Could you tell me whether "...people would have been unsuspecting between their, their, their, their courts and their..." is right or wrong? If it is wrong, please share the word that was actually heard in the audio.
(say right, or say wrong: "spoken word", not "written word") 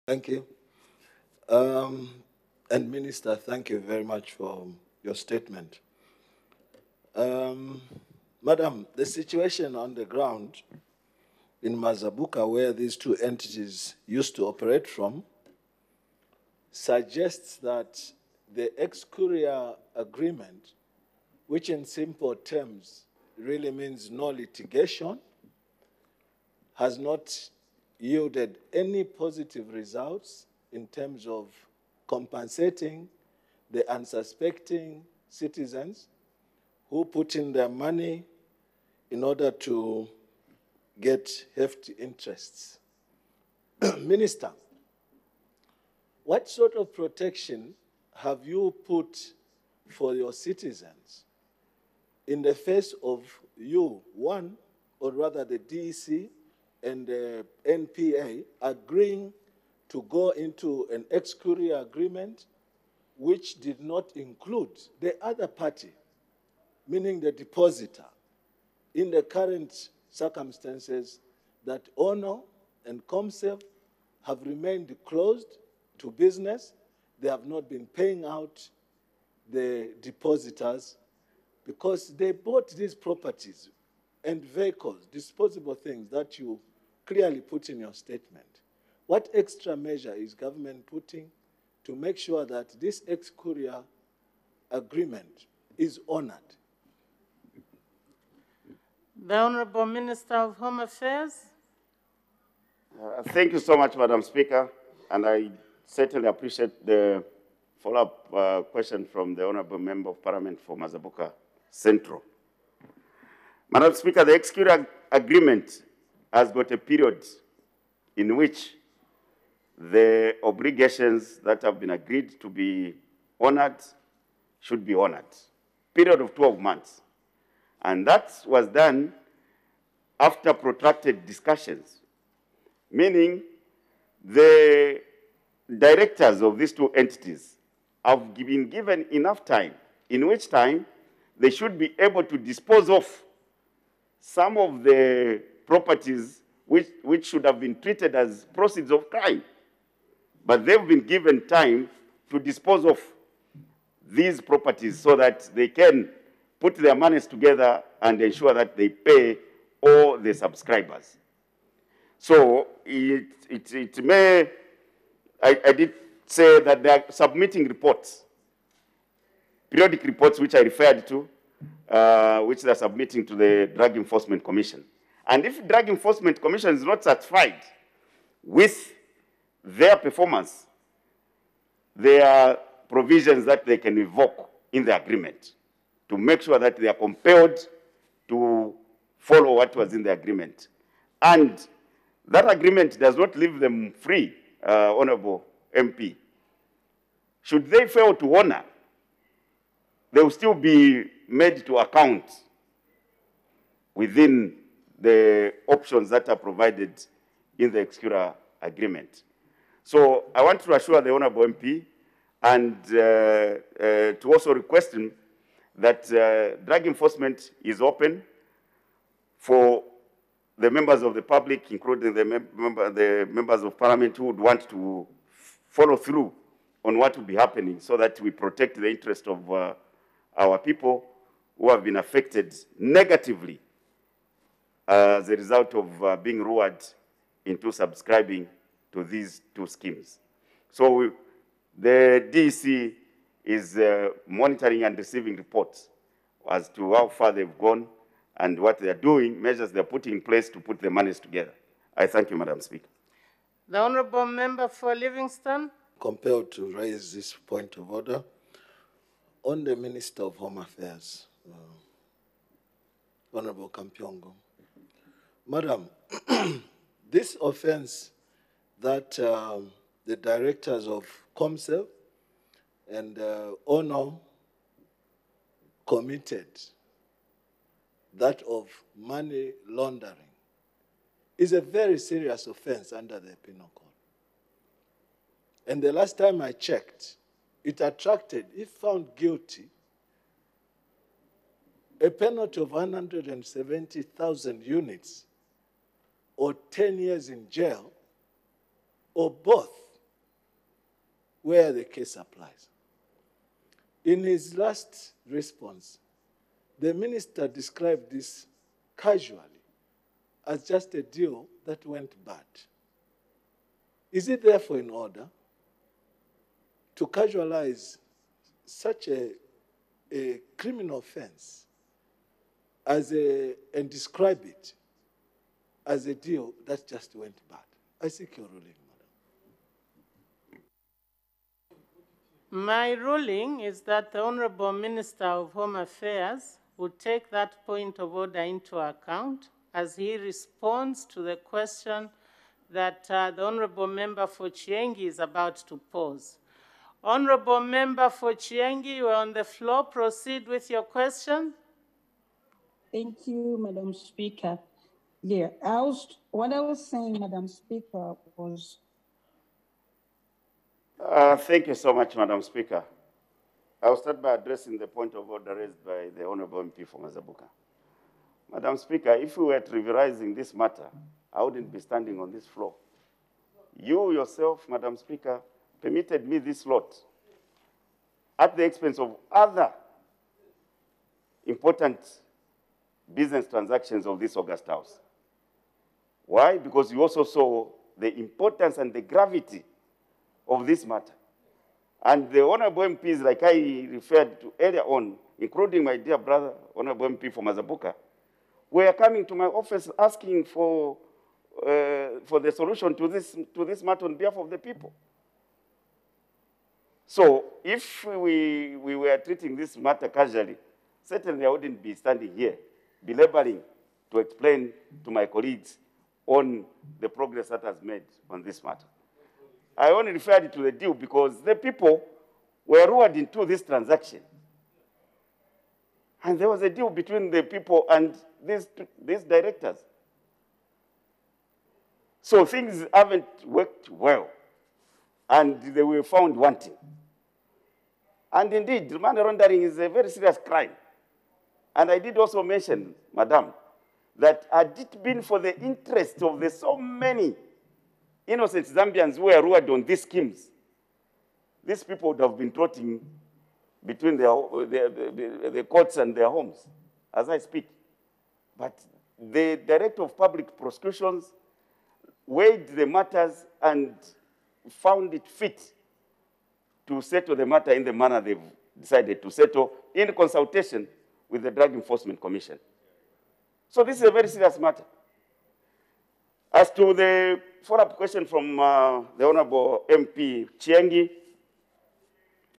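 wrong: "trotting", not "unsuspecting".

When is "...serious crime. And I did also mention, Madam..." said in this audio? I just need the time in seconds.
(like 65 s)
440 s.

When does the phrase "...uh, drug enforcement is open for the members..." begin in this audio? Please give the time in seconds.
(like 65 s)
216 s.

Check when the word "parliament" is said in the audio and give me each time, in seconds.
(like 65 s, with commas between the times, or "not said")
110 s, 223 s.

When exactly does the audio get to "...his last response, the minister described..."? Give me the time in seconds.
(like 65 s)
304 s.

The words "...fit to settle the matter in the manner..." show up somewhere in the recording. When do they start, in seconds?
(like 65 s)
465 s.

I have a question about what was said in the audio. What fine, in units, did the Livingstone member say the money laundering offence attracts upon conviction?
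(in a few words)
170,000 units.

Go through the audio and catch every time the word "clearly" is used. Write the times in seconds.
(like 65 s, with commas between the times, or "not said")
87 s.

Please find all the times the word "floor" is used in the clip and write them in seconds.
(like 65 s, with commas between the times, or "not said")
349 s, 372 s.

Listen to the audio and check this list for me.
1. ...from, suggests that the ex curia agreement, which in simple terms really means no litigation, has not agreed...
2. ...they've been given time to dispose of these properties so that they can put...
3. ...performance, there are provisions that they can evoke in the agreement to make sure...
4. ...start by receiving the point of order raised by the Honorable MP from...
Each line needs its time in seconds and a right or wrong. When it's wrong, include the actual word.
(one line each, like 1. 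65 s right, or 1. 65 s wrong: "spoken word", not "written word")
1. 14 s wrong: "yielded", not "agreed"
2. 150 s right
3. 179 s right
4. 363 s wrong: "addressing", not "receiving".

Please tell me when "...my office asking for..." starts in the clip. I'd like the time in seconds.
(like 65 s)
399 s.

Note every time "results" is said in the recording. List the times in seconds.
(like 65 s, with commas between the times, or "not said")
29 s, 235 s.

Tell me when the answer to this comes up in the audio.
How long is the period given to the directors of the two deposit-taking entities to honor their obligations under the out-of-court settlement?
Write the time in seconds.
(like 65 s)
125 s.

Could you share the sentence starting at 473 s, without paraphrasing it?
So this is a very serious matter.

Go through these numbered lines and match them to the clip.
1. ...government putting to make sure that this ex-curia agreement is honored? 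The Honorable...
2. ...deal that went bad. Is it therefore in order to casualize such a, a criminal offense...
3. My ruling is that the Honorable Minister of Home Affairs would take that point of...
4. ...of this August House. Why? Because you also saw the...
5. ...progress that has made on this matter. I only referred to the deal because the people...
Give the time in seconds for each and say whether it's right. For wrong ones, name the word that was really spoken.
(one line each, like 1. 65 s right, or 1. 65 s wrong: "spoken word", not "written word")
1. 90 s right
2. 311 s right
3. 332 s right
4. 384 s right
5. 417 s right.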